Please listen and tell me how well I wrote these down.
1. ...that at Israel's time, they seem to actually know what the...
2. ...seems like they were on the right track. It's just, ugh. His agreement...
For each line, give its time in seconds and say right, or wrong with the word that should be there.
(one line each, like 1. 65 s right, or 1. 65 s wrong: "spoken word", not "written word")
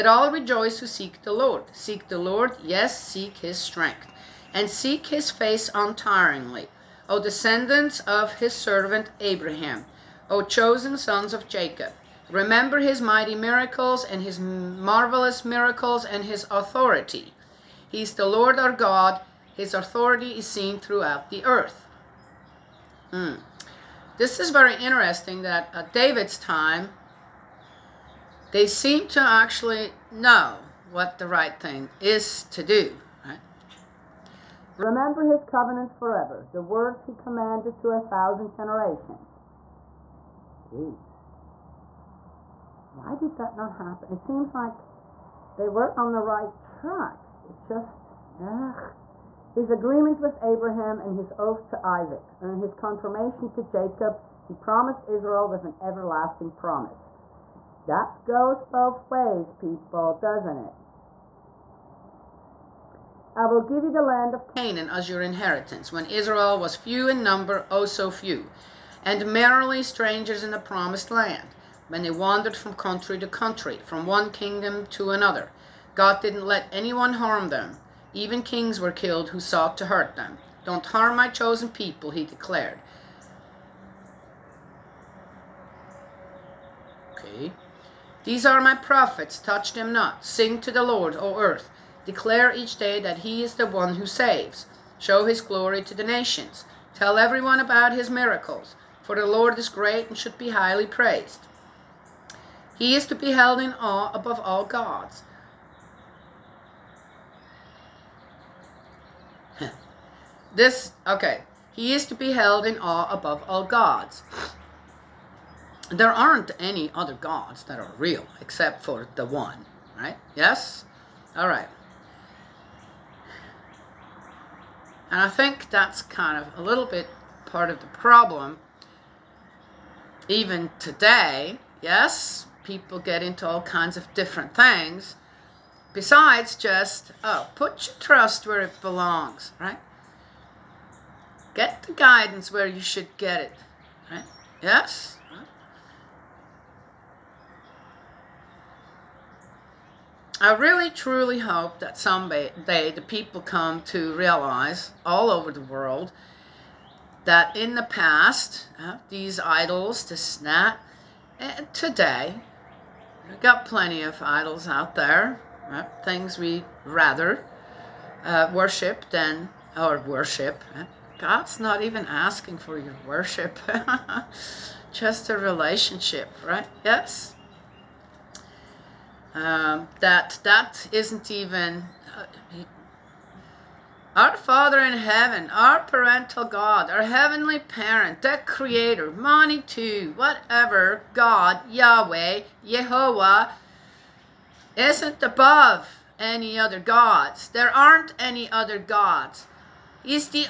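1. 25 s wrong: "David", not "Israel"
2. 44 s right.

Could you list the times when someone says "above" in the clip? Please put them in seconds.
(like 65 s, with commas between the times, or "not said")
104 s, 113 s, 195 s.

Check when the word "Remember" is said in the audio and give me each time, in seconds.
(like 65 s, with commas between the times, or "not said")
12 s, 34 s.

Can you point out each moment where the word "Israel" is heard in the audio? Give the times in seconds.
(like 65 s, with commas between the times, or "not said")
55 s, 66 s.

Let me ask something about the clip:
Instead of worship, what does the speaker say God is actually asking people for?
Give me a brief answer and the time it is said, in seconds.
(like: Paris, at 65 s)
A relationship, at 174 s.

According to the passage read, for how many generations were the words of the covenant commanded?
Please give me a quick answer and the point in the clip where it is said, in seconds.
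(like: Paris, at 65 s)
1000, at 37 s.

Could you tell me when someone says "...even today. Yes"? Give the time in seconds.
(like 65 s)
130 s.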